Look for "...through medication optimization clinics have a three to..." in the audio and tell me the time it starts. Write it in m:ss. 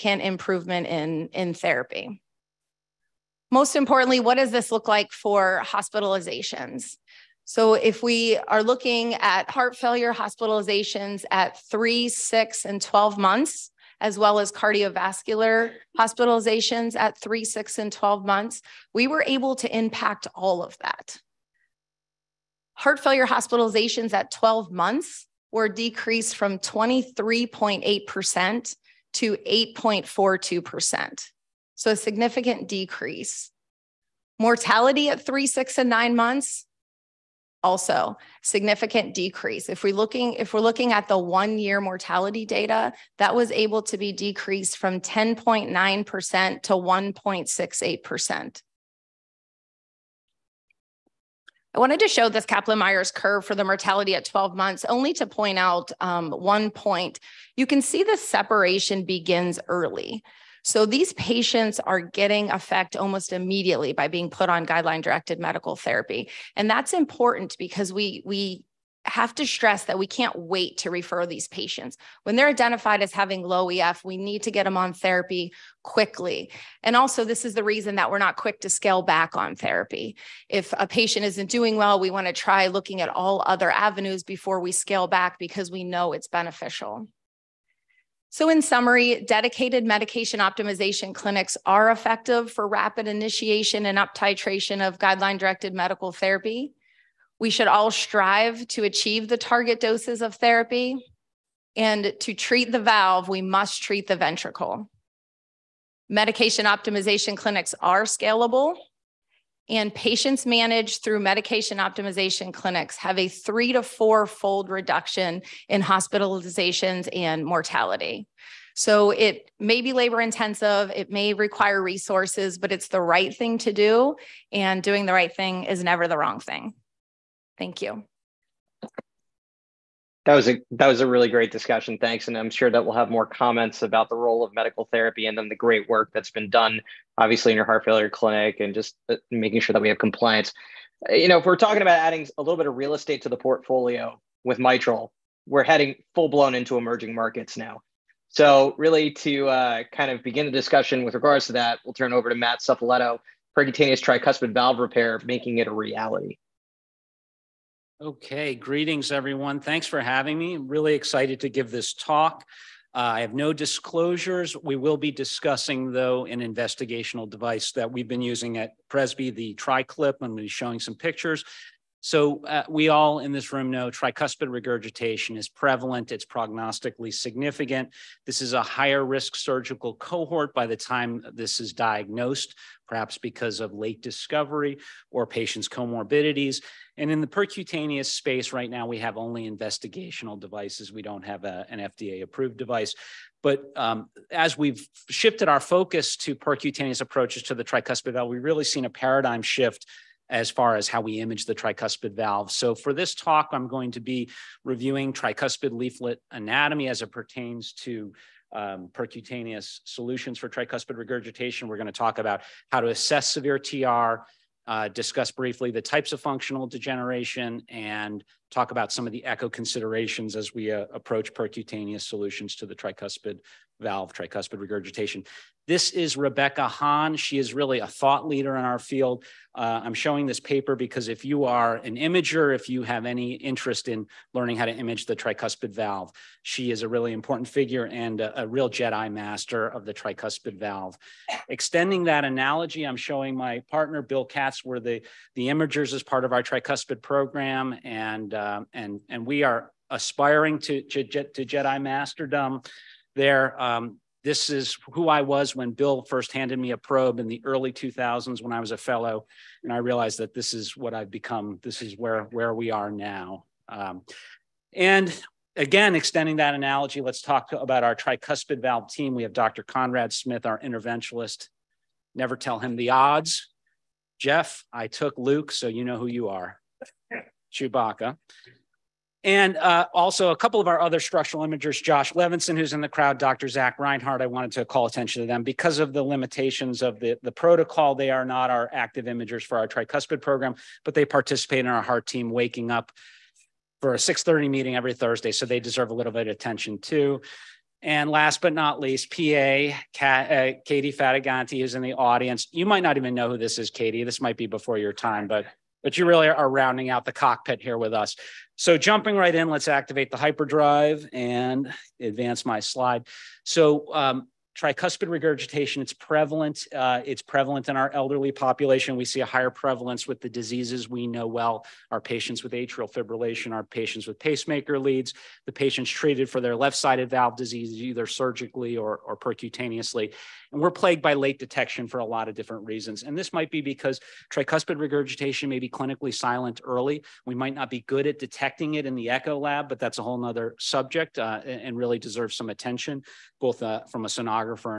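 1:51.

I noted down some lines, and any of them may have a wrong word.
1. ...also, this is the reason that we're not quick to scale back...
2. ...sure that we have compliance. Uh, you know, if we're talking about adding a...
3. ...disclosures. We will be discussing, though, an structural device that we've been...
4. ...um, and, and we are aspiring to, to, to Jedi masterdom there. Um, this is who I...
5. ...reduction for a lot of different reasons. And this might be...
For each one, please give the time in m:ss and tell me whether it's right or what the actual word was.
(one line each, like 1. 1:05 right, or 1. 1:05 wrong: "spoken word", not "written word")
1. 1:16 right
2. 2:19 right
3. 2:43 wrong: "investigational", not "structural"
4. 4:08 right
5. 5:31 wrong: "detection", not "reduction".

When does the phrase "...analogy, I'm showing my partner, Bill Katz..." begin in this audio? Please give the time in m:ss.
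4:02.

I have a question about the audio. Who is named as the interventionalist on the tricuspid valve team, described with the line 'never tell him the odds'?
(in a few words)
Conrad Smith.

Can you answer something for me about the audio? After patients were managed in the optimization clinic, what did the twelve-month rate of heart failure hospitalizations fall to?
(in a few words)
8.42%.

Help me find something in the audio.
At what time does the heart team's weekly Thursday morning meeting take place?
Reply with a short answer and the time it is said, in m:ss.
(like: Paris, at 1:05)
6:30, at 4:53.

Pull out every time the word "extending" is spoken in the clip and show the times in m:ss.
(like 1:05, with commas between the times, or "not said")
4:01, 4:25.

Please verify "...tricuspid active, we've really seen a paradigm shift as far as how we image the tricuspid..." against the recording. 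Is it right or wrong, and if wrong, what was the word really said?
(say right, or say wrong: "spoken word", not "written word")
wrong: "valve", not "active".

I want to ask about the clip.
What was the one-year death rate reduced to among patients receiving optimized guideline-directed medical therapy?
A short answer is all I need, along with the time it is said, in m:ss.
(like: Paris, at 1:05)
1.68%, at 0:46.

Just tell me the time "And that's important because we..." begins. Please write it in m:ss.
1:06.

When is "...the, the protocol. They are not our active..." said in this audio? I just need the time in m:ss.
4:46.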